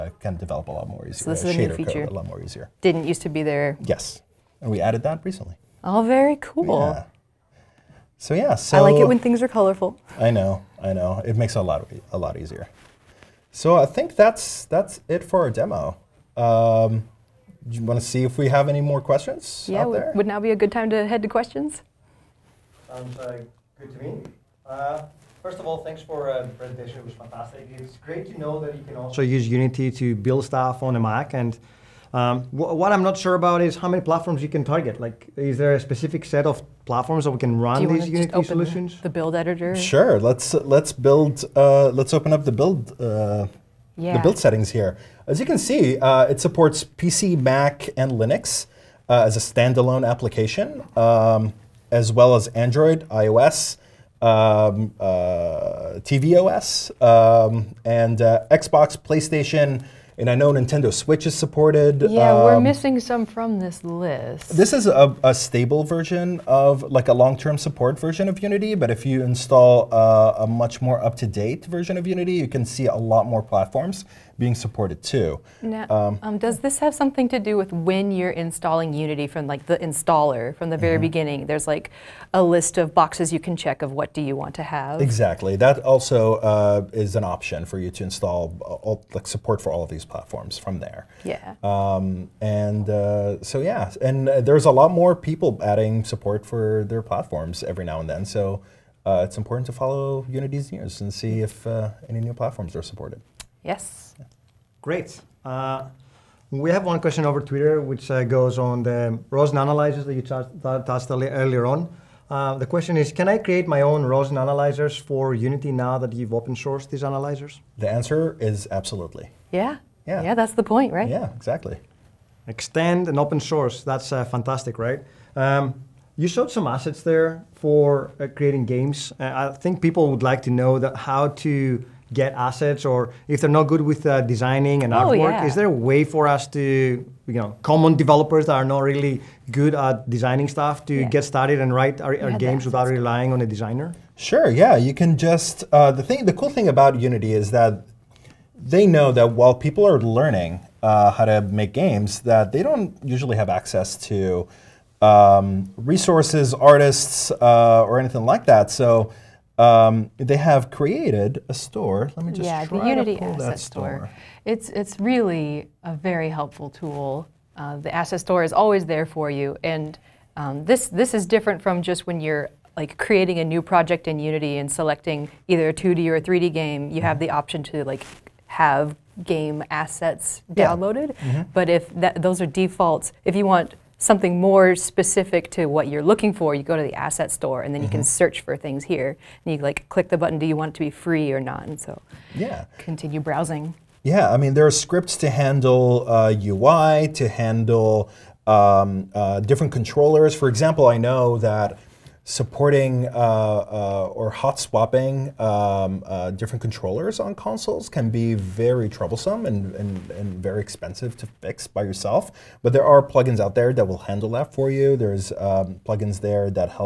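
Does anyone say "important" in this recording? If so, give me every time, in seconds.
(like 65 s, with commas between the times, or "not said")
99 s.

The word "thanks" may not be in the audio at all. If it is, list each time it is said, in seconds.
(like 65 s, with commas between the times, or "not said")
25 s.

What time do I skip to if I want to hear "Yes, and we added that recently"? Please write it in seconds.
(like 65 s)
3 s.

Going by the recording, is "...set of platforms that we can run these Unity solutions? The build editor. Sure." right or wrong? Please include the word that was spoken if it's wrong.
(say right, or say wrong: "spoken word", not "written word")
right.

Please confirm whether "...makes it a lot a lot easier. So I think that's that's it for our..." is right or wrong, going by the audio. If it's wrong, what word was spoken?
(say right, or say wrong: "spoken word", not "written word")
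right.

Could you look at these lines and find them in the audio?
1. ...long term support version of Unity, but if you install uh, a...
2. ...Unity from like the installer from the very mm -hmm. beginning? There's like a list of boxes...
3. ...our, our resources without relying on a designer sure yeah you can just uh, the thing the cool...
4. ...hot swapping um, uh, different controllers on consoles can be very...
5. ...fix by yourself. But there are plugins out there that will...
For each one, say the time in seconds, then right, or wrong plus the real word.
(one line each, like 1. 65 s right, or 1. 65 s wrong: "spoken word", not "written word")
1. 67 s right
2. 78 s right
3. 142 s wrong: "games", not "resources"
4. 204 s right
5. 211 s right.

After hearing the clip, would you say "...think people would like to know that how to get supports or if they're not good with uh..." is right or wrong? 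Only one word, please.
wrong.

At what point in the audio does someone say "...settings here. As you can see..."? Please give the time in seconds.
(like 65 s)
44 s.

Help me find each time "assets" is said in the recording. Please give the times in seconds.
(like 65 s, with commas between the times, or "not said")
126 s, 132 s, 163 s, 167 s, 179 s, 186 s.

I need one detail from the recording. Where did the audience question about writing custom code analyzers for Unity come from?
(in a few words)
Twitter.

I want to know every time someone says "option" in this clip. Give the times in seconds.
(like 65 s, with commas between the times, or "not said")
87 s, 177 s.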